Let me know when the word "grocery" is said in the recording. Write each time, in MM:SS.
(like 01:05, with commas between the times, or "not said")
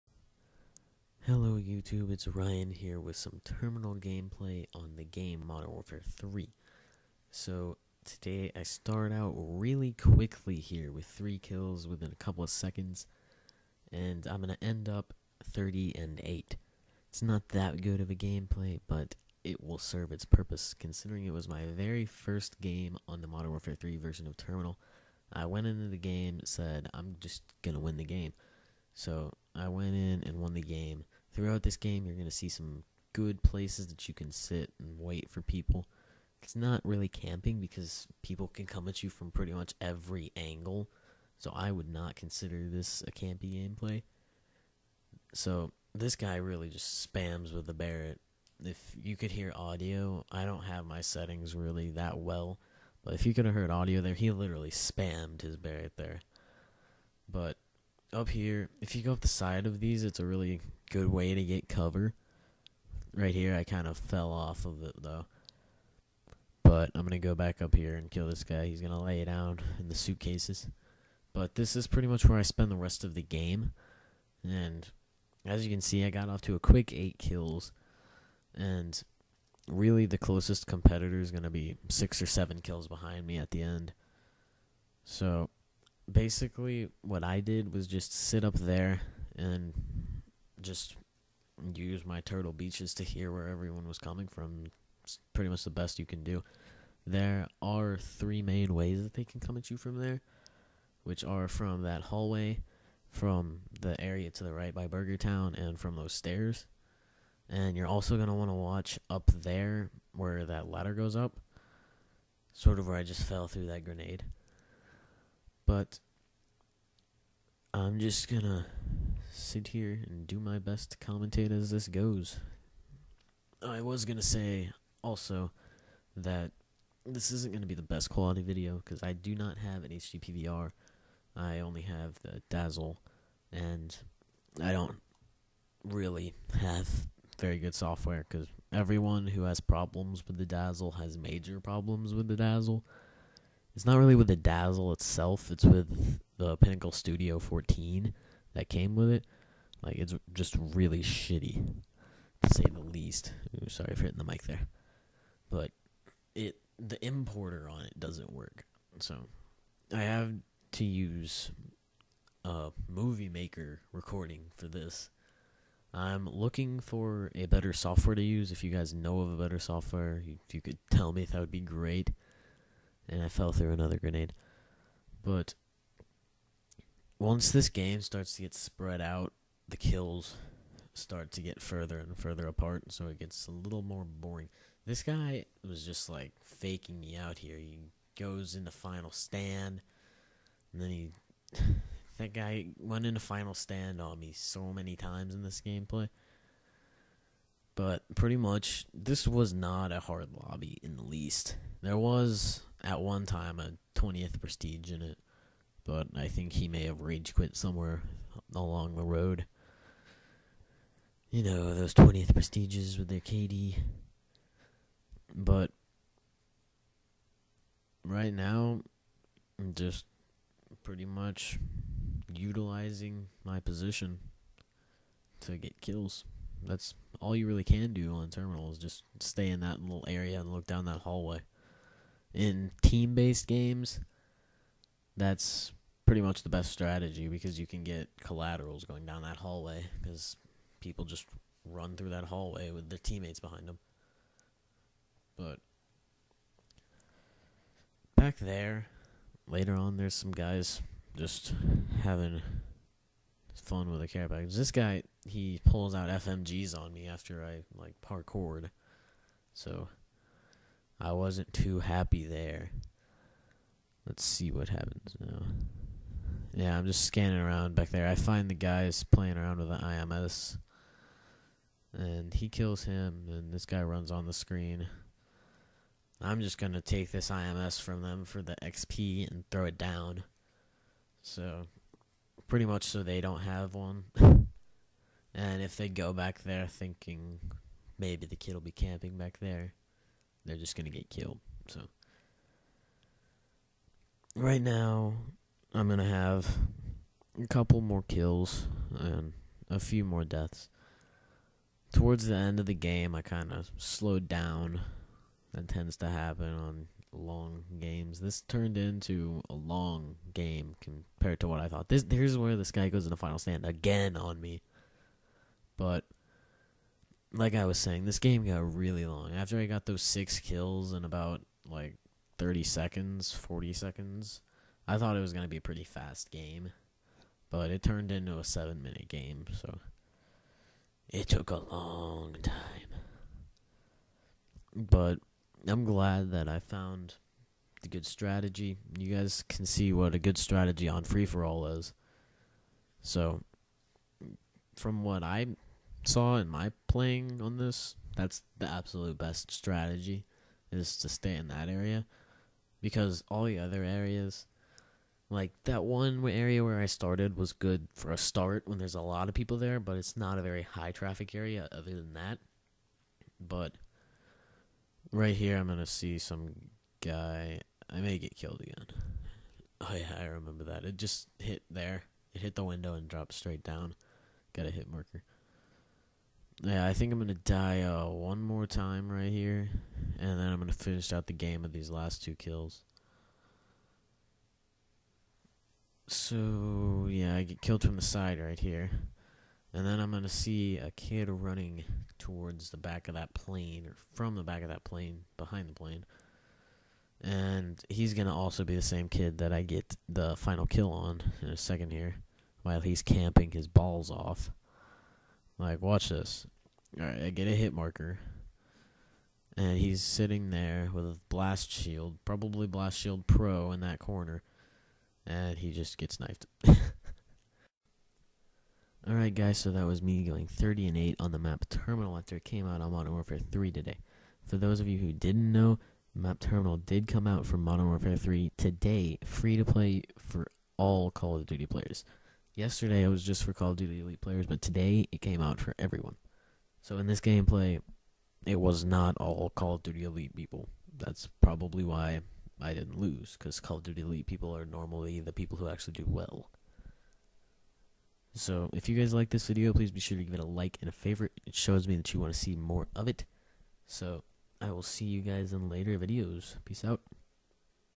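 not said.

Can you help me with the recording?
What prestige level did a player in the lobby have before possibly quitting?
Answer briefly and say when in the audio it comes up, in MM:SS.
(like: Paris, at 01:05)
20th prestige, at 03:23.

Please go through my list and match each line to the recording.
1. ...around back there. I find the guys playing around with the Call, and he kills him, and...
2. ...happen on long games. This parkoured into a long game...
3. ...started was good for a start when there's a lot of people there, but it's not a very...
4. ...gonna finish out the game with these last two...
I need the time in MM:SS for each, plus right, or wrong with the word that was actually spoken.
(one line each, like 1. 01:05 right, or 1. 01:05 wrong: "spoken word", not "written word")
1. 04:27 wrong: "IMS", not "Call"
2. 05:06 wrong: "turned", not "parkoured"
3. 05:56 right
4. 06:20 right.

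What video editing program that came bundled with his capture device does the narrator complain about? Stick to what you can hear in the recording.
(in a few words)
Pinnacle Studio 14.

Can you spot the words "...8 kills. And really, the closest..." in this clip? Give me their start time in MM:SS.
01:16.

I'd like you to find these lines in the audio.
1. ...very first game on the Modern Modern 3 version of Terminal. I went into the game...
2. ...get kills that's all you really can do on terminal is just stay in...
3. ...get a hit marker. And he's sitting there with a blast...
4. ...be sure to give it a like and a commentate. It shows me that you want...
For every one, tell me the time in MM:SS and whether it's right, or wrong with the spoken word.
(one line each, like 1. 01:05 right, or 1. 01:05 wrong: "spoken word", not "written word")
1. 00:21 wrong: "Warfare", not "Modern"
2. 03:45 right
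3. 06:47 right
4. 07:29 wrong: "favorite", not "commentate".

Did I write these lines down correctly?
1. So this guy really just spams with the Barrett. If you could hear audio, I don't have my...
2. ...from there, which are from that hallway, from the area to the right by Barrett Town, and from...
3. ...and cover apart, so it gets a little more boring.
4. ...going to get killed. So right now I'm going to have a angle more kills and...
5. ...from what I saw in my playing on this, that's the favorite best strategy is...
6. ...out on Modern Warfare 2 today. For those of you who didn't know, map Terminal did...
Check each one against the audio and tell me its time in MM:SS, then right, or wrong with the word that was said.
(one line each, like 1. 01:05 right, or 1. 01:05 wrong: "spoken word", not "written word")
1. 00:45 right
2. 01:39 wrong: "Burger", not "Barrett"
3. 03:01 wrong: "further", not "cover"
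4. 04:50 wrong: "couple", not "angle"
5. 05:44 wrong: "absolute", not "favorite"
6. 07:02 wrong: "3", not "2".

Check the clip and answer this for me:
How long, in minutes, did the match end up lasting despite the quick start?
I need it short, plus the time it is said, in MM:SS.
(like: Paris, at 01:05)
7 minutes, at 05:28.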